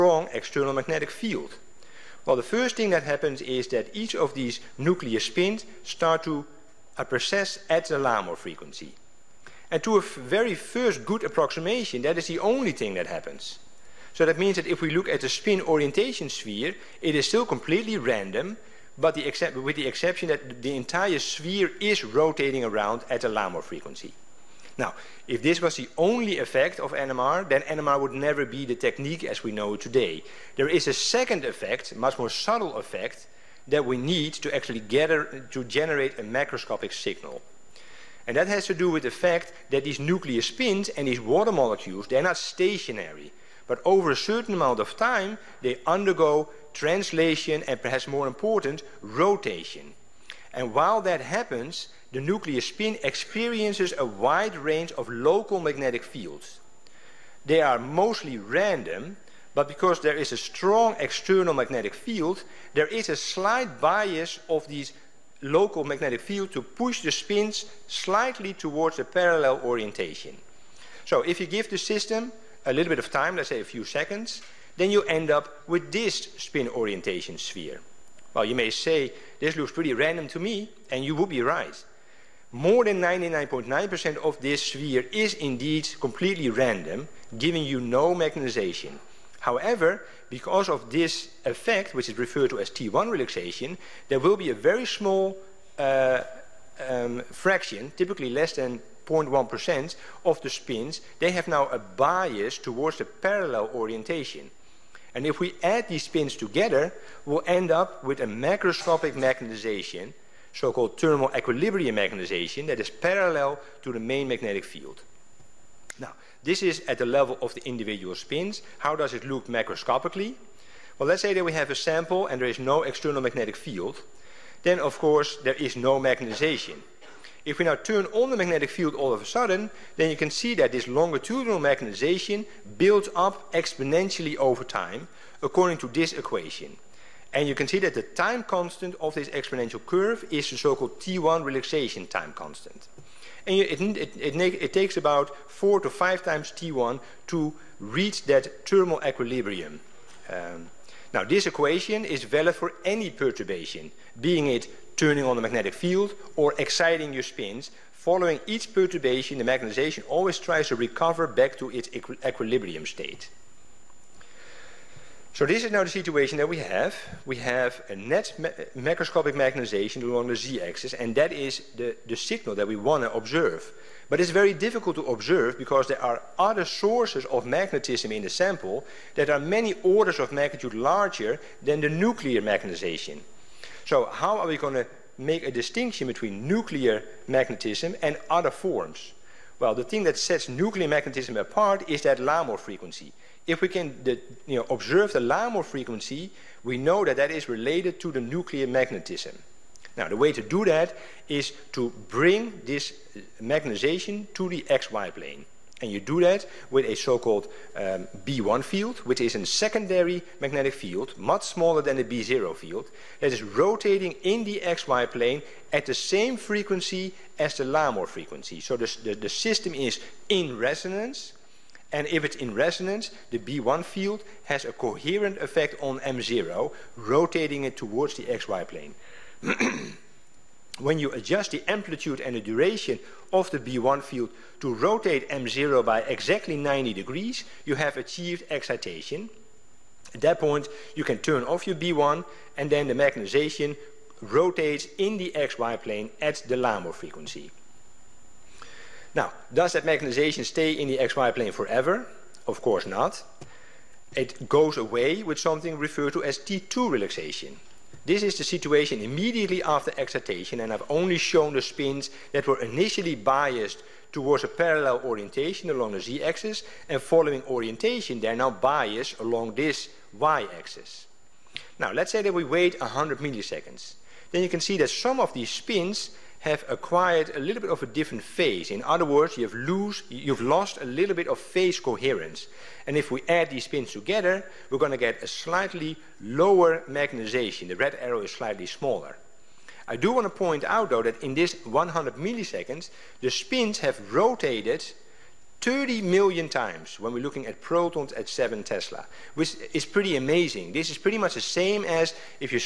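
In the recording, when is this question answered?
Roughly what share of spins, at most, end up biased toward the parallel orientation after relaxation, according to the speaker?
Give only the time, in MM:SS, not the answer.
01:38.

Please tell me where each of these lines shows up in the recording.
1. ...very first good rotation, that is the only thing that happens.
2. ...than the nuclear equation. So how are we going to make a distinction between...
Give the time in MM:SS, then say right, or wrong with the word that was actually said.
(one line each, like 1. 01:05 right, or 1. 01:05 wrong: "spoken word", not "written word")
1. 00:10 wrong: "approximation", not "rotation"
2. 03:01 wrong: "magnetization", not "equation".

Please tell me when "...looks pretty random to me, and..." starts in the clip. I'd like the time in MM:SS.
01:19.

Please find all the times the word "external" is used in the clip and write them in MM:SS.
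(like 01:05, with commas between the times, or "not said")
00:00, 01:00, 02:02.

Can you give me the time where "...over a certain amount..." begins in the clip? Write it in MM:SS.
00:43.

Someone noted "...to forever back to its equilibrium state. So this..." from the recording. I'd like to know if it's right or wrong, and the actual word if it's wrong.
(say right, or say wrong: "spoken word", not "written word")
wrong: "recover", not "forever".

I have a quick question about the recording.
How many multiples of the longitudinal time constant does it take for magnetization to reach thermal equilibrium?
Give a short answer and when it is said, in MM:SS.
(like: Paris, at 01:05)
4 to 5, at 02:25.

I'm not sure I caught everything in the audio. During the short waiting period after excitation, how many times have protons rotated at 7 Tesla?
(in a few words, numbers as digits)
30 million.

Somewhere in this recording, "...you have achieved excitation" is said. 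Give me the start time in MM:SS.
03:57.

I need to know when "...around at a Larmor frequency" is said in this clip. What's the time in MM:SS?
00:22.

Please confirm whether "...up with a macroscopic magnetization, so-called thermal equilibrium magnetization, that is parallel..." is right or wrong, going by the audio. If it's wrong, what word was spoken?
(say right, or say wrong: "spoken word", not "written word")
right.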